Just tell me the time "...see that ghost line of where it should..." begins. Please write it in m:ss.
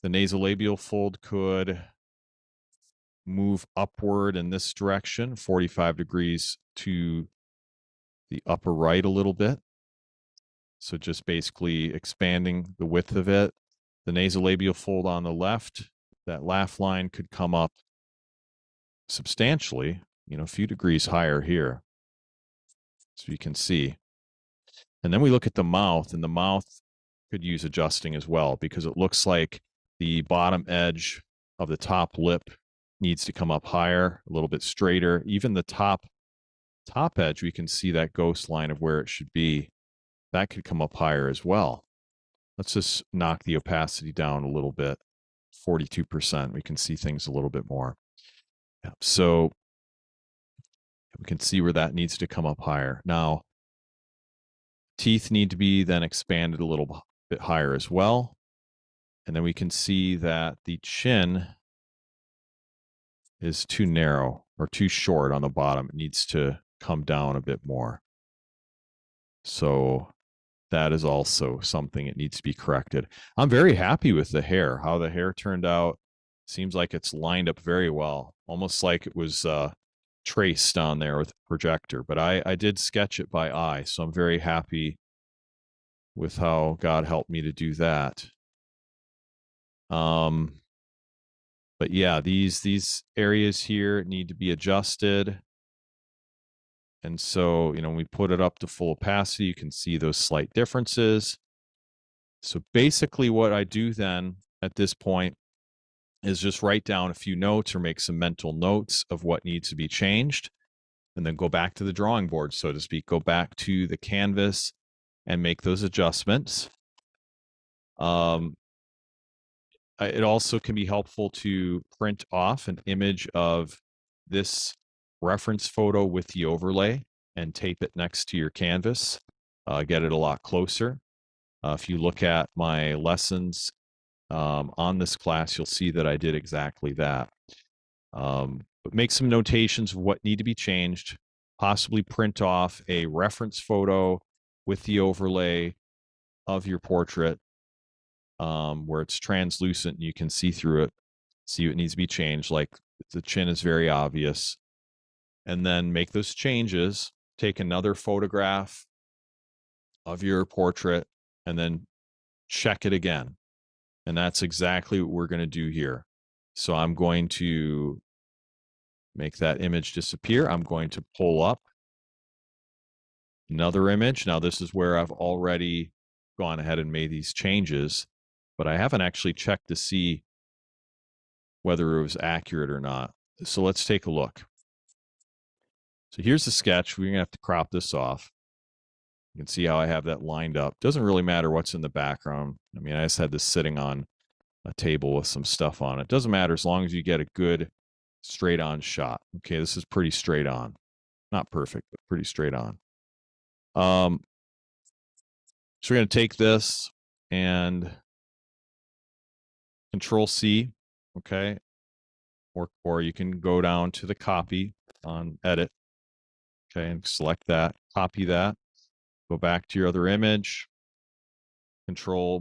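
0:37.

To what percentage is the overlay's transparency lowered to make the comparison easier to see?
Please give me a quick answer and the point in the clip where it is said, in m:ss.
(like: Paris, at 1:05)
42%, at 0:45.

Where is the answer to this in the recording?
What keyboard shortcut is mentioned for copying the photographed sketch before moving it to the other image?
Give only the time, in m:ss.
3:29.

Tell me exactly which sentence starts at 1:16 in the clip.
Seems like it's lined up very well, almost like it was uh, traced on there with projector.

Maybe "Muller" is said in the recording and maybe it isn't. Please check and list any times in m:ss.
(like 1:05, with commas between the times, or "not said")
not said.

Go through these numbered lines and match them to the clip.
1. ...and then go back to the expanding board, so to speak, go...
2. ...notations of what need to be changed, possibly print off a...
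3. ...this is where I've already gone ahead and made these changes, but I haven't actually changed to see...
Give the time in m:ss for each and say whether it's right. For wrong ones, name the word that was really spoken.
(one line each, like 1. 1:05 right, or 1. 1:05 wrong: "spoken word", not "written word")
1. 1:51 wrong: "drawing", not "expanding"
2. 2:19 right
3. 2:54 wrong: "checked", not "changed".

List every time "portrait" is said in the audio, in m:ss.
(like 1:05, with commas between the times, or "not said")
2:26, 2:40.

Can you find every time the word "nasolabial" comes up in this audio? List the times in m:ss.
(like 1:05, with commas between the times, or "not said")
0:00, 0:14.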